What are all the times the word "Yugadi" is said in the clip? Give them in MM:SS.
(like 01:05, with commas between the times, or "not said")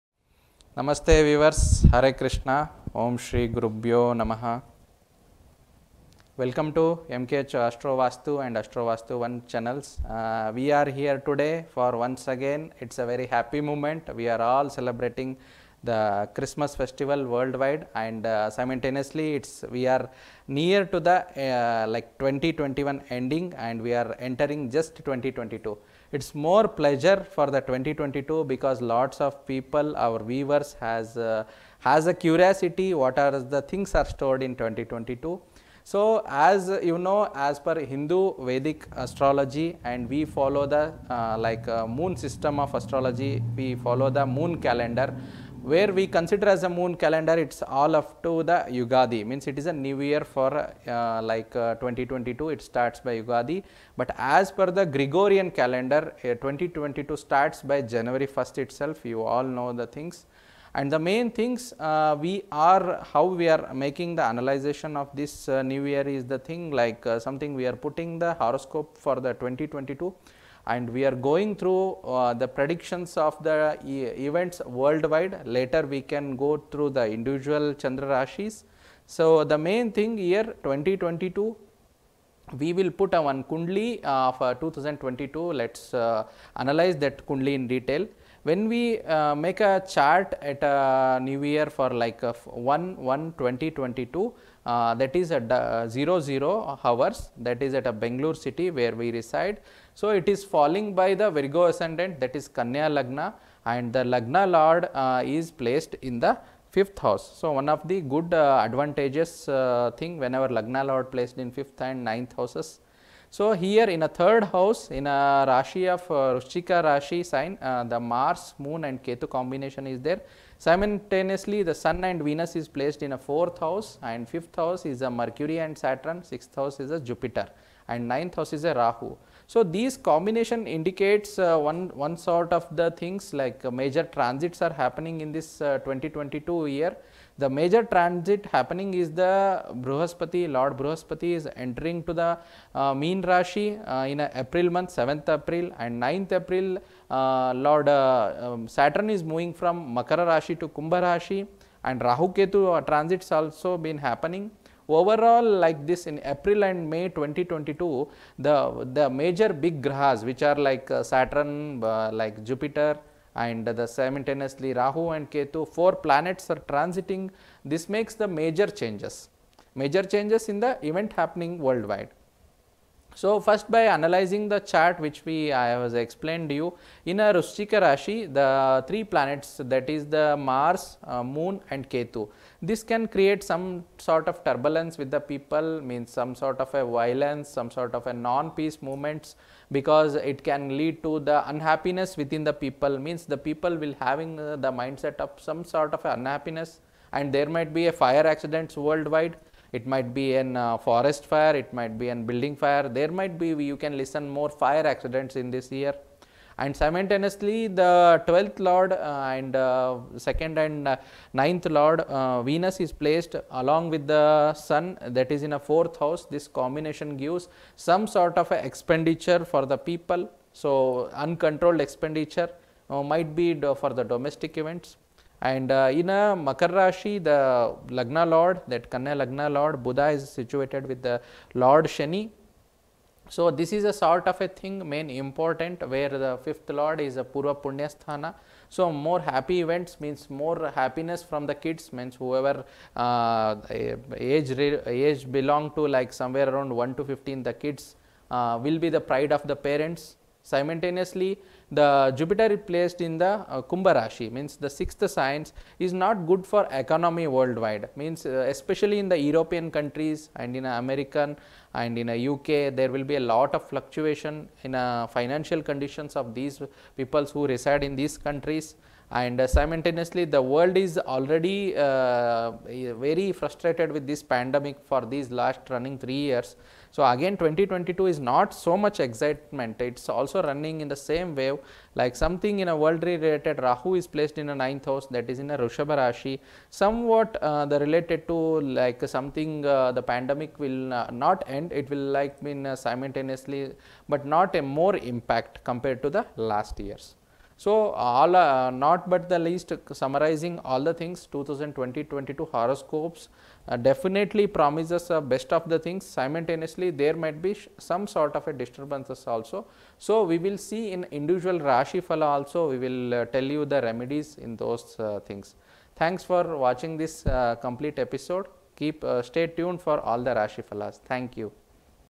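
00:48, 00:53.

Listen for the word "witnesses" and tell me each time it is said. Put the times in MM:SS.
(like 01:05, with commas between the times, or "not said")
not said.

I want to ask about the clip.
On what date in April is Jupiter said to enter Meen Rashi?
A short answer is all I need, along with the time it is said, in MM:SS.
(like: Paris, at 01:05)
7th April, at 02:24.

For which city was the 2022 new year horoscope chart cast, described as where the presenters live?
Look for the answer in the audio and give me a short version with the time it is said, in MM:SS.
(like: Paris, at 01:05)
Bangalore, at 01:37.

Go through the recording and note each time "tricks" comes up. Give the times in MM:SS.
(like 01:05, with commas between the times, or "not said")
not said.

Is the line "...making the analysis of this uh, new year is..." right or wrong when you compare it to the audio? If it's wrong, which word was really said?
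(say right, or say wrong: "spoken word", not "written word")
right.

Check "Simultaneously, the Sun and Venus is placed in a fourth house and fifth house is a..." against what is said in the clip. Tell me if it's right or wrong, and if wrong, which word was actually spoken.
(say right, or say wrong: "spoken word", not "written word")
right.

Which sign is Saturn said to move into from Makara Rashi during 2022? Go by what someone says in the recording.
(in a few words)
Kumbha Rashi.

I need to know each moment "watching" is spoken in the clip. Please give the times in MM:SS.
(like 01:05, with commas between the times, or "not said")
05:16.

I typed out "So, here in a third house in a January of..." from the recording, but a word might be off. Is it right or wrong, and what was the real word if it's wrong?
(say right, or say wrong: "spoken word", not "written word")
wrong: "Rashi", not "January".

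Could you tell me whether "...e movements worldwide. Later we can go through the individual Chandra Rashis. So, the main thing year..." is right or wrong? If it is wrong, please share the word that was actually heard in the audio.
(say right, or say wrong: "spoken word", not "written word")
wrong: "events", not "movements".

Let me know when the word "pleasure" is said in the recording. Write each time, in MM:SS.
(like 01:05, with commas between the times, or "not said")
00:26.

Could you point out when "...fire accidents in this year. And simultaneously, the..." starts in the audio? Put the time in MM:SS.
03:24.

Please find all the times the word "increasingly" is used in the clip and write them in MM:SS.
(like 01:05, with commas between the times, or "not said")
not said.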